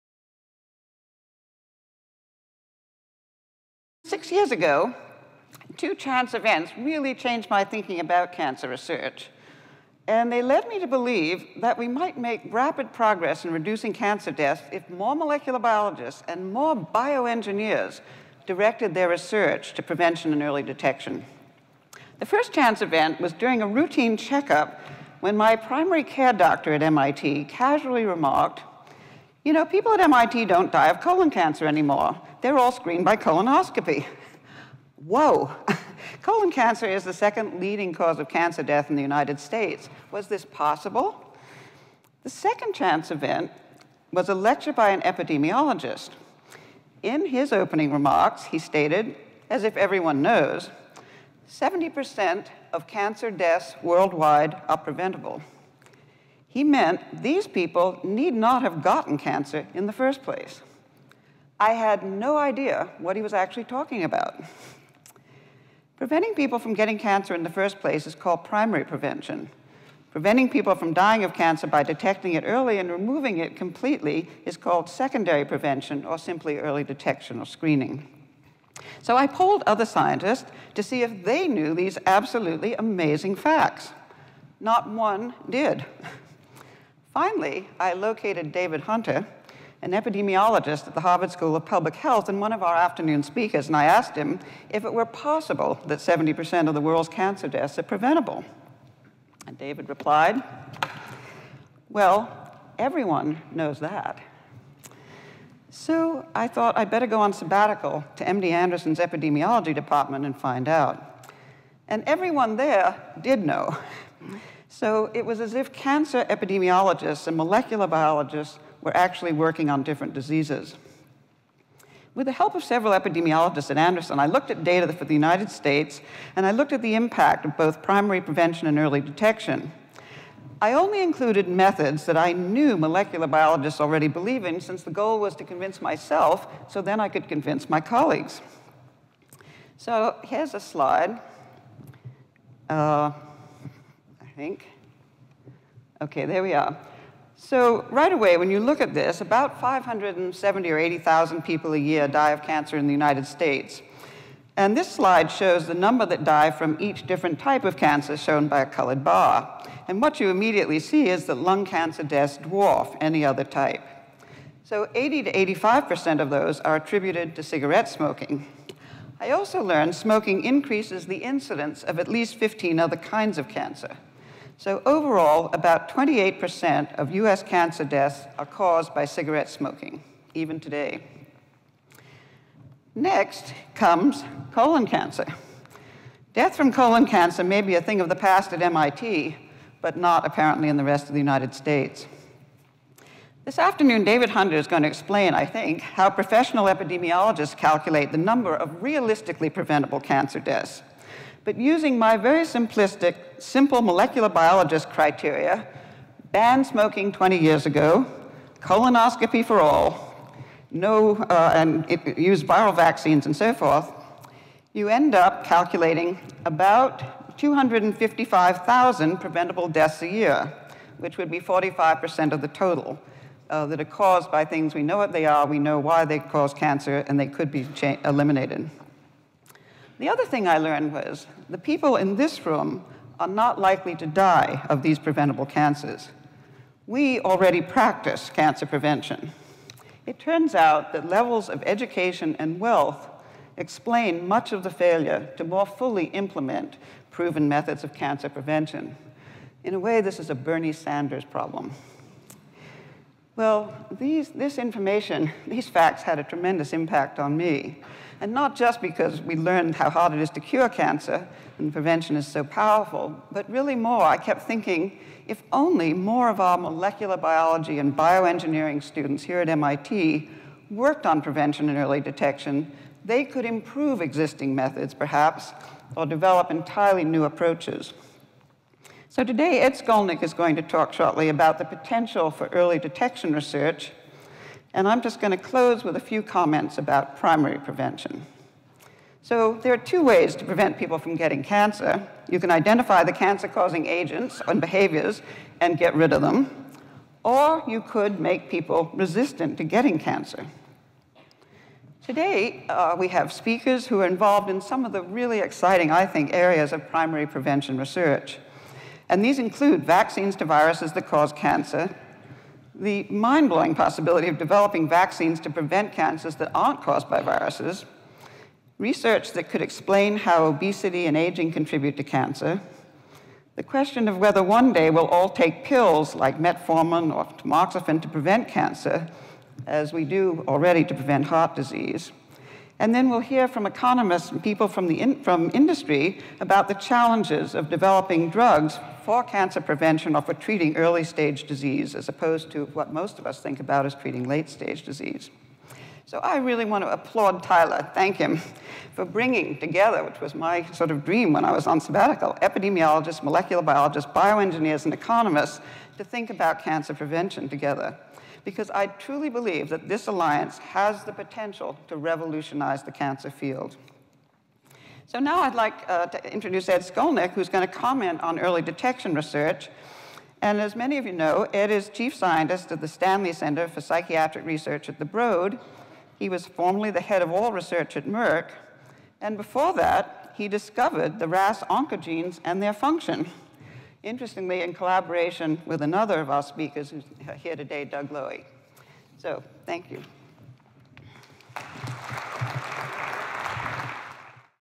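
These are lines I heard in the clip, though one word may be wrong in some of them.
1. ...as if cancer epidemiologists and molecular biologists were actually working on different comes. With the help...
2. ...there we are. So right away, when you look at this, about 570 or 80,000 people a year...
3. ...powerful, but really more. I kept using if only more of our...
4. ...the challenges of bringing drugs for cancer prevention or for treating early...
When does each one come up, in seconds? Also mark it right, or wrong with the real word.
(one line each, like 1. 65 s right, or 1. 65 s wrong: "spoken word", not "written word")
1. 115 s wrong: "diseases", not "comes"
2. 146 s right
3. 262 s wrong: "thinking", not "using"
4. 336 s wrong: "developing", not "bringing".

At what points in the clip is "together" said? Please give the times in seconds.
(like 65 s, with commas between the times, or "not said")
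349 s, 357 s.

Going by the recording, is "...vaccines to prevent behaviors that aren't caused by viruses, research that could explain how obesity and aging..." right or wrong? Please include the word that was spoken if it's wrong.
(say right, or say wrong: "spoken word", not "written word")
wrong: "cancers", not "behaviors".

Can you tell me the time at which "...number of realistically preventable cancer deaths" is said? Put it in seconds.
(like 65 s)
198 s.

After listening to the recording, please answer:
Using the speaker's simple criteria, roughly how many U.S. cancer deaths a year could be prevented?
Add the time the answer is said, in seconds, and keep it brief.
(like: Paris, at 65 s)
255,000, at 217 s.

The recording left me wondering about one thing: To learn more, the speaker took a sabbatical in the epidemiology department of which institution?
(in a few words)
MD Anderson.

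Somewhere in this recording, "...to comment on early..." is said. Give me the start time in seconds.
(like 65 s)
367 s.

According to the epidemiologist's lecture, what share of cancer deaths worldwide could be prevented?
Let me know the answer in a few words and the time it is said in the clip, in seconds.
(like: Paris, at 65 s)
70%, at 51 s.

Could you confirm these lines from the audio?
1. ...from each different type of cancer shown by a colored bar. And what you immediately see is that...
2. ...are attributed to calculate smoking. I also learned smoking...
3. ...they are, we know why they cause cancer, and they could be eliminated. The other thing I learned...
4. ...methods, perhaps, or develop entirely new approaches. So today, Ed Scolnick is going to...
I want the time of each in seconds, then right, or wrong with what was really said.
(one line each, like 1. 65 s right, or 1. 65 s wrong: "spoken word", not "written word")
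1. 156 s right
2. 166 s wrong: "cigarette", not "calculate"
3. 225 s right
4. 274 s right.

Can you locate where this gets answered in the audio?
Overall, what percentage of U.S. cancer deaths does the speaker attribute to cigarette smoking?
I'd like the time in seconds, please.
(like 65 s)
175 s.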